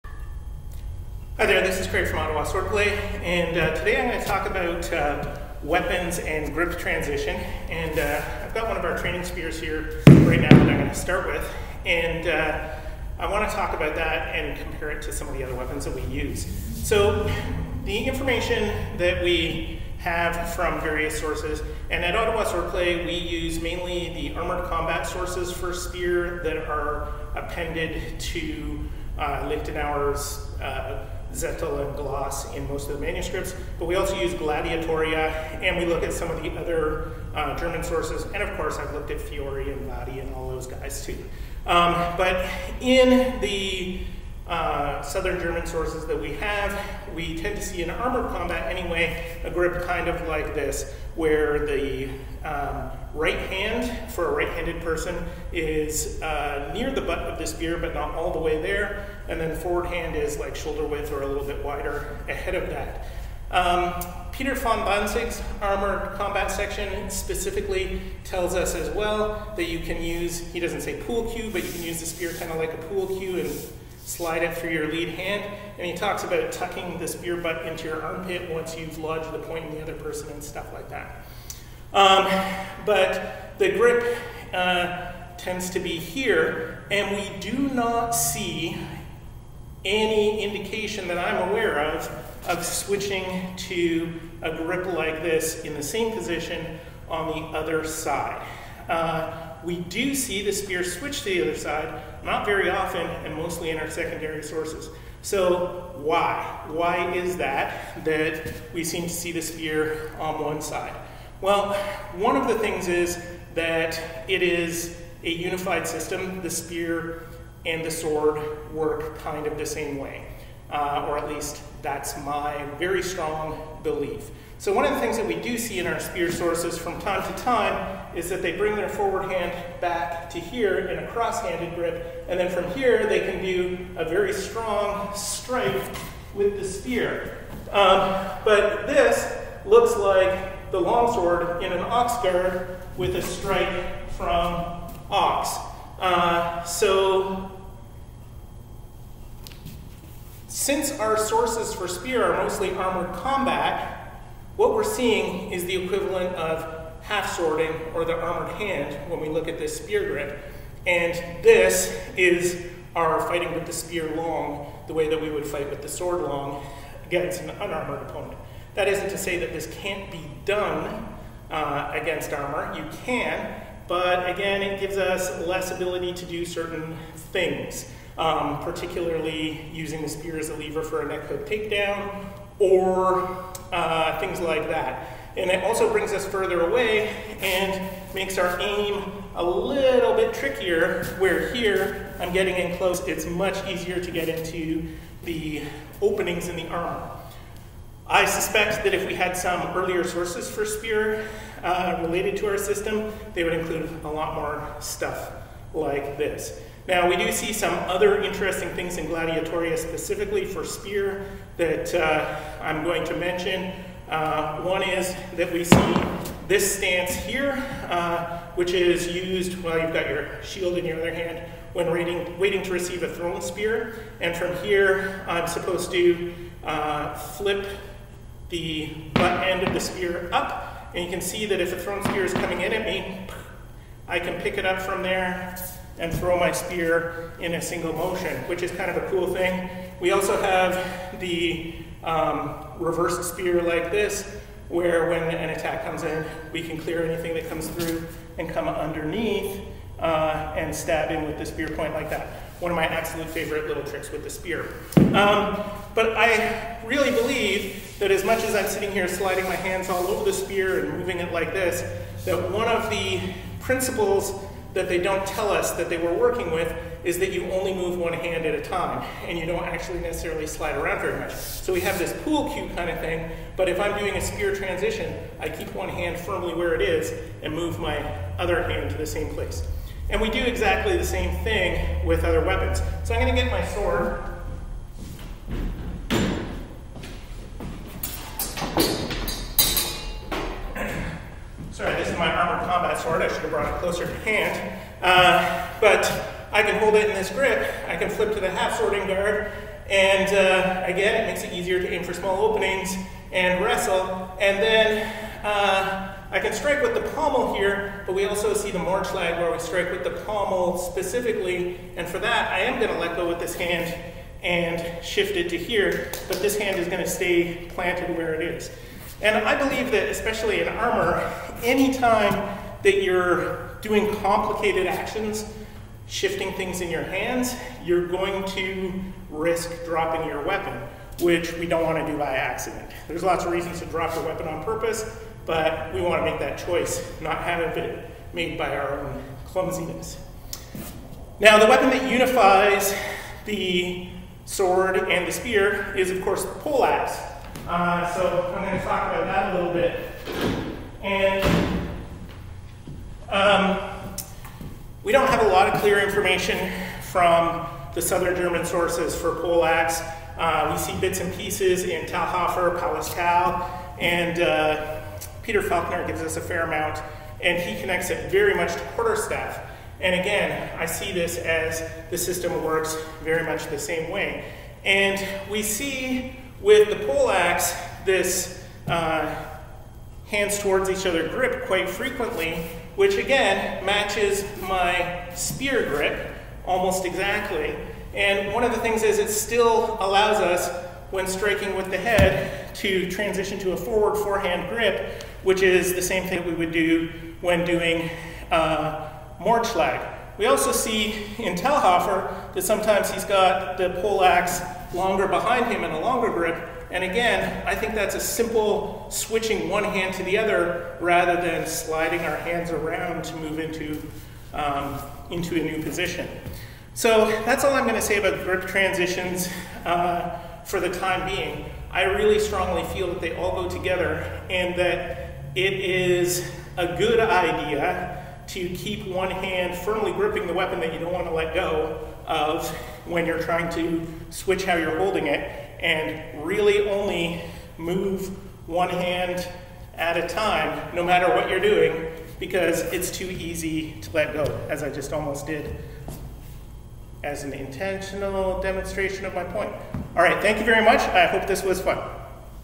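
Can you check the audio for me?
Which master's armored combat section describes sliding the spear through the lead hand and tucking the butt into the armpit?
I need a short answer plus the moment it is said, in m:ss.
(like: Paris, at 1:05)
Peter von Danzig, at 1:04.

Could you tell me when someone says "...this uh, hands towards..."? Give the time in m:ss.
6:18.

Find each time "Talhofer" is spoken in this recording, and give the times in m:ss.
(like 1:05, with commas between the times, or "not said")
6:02, 6:41.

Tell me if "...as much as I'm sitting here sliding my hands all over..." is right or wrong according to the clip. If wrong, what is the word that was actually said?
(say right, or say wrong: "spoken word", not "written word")
right.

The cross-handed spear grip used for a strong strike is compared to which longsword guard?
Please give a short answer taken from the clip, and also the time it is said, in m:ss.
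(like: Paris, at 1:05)
Ox guard, at 2:21.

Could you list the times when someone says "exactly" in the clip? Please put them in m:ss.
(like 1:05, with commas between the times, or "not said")
4:40, 6:27.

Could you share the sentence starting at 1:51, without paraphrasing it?
Well, one of the things is that it is a unified system.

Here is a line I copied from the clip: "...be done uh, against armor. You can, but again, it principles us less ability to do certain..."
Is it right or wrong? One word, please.
wrong.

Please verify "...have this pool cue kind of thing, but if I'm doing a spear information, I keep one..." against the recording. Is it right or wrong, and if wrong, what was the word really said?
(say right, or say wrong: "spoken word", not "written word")
wrong: "transition", not "information".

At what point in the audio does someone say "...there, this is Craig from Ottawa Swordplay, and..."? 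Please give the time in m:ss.
0:01.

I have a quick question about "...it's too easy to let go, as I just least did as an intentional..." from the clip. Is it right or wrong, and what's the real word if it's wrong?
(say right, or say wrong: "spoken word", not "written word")
wrong: "almost", not "least".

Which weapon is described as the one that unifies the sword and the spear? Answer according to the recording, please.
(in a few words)
Poleaxe.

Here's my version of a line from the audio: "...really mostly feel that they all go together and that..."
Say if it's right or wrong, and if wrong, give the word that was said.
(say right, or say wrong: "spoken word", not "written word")
wrong: "strongly", not "mostly".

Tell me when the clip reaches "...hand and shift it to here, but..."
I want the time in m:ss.
5:13.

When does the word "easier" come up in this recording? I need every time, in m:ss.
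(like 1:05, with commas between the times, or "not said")
3:13, 5:01.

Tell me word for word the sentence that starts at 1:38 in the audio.
Uh, we do see the spear switch to the other side, not very often, and mostly in our secondary sources.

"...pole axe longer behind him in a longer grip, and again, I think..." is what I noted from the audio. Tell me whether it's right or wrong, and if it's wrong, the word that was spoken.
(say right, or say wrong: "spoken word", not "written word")
right.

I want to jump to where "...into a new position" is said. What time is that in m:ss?
6:55.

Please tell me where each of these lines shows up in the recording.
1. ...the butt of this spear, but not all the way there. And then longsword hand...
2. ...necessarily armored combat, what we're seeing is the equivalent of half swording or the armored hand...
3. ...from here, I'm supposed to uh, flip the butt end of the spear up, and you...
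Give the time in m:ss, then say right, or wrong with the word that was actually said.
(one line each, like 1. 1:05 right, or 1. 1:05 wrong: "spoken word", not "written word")
1. 0:56 wrong: "forward", not "longsword"
2. 2:32 wrong: "mostly", not "necessarily"
3. 3:44 right.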